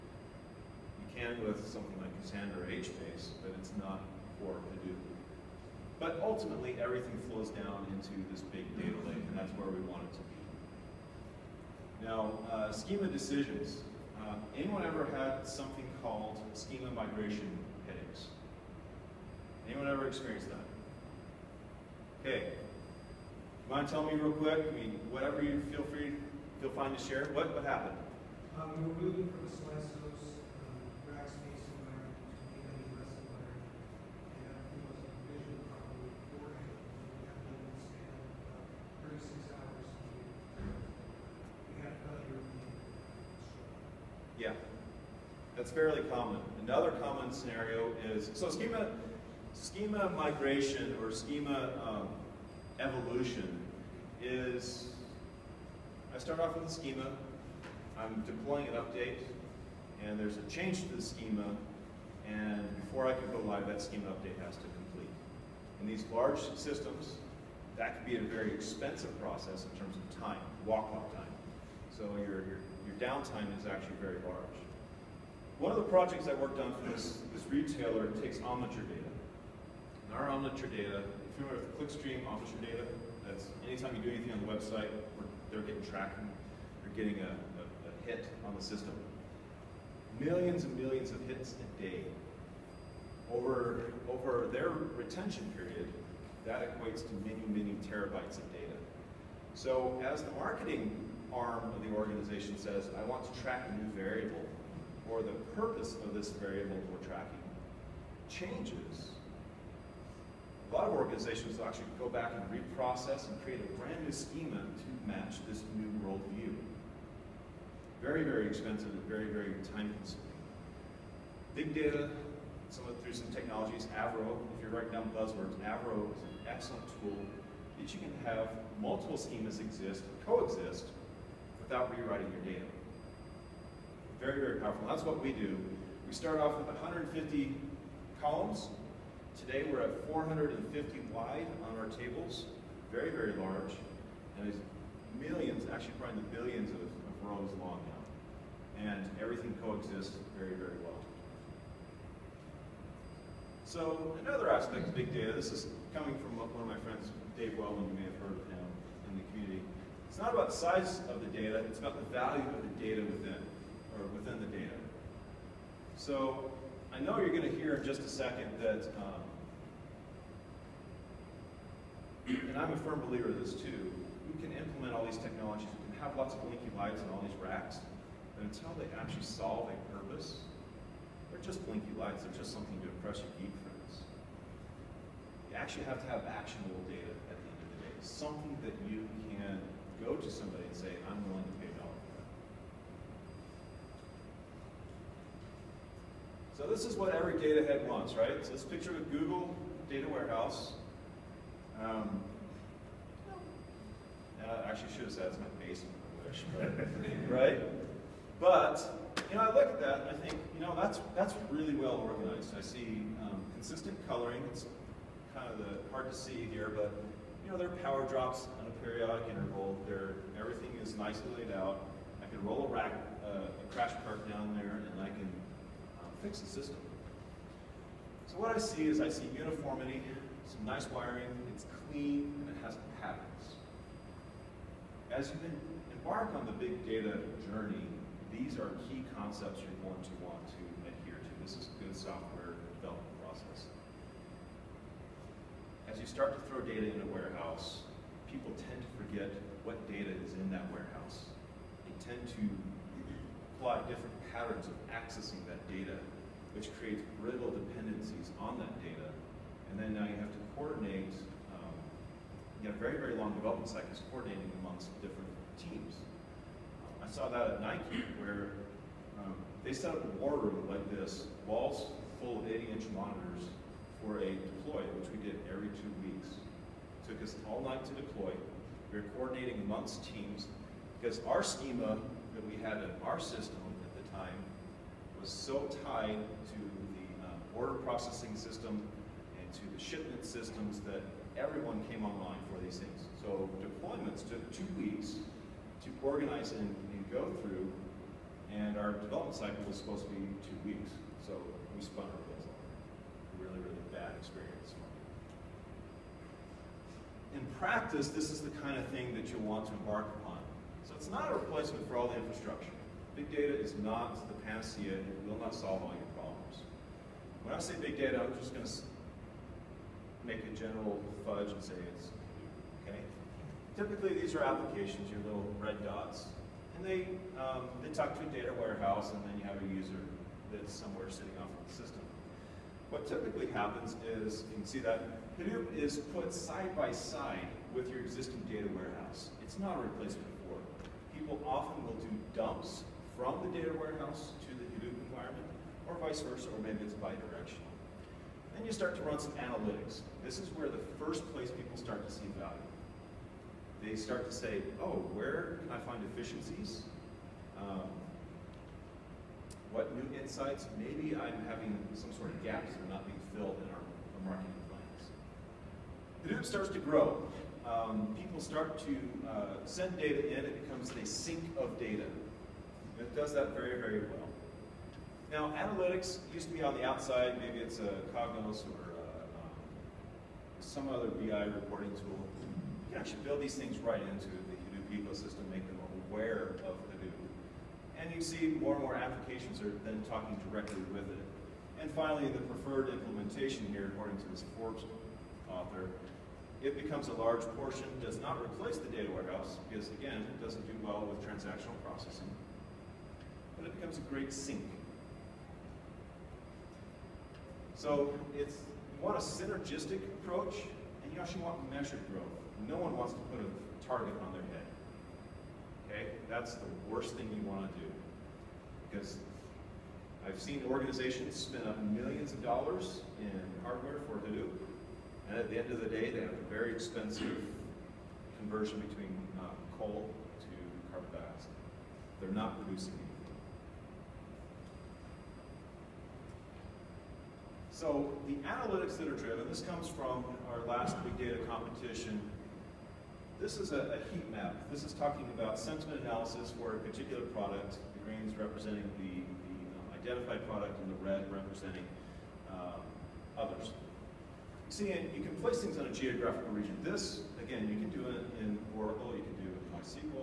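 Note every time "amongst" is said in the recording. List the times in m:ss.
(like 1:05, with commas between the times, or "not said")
4:24, 4:39.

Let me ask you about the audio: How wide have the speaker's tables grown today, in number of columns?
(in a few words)
450.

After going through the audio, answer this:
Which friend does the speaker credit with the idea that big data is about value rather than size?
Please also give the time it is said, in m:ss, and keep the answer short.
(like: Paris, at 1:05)
Dave Wellman, at 2:37.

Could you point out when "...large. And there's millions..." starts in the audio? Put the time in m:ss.
2:23.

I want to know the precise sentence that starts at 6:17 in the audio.
Maybe it's a Cognos or a, uh, um, some other BI reporting tool.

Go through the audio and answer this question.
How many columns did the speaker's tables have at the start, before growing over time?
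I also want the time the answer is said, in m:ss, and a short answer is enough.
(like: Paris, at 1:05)
150, at 2:16.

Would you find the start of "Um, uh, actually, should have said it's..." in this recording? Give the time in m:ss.
3:21.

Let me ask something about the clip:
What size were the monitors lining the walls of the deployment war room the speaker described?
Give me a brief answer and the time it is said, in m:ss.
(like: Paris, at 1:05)
80 inch, at 4:32.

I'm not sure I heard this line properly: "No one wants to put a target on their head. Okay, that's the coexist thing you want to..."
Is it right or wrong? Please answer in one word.
wrong.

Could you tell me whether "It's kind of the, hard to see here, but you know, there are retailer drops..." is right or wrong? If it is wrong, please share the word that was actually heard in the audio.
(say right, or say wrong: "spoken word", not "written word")
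wrong: "power", not "retailer".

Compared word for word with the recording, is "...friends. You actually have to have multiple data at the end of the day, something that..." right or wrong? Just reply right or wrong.
wrong.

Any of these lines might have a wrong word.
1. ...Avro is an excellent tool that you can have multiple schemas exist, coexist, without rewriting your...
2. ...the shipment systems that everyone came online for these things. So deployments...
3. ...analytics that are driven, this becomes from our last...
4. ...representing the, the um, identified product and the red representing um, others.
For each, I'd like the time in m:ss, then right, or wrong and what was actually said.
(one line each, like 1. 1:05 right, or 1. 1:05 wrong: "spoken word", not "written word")
1. 2:05 right
2. 4:49 right
3. 7:18 wrong: "comes", not "becomes"
4. 7:28 right.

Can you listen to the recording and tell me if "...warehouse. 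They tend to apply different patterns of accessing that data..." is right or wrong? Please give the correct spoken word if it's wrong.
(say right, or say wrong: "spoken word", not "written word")
right.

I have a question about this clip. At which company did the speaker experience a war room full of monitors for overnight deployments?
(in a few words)
Nike.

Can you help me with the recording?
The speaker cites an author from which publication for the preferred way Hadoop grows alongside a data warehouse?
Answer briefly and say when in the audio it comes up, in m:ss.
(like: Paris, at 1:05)
Forbes, at 6:34.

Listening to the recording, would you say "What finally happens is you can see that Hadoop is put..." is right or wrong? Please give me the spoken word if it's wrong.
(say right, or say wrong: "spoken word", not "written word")
wrong: "typically", not "finally".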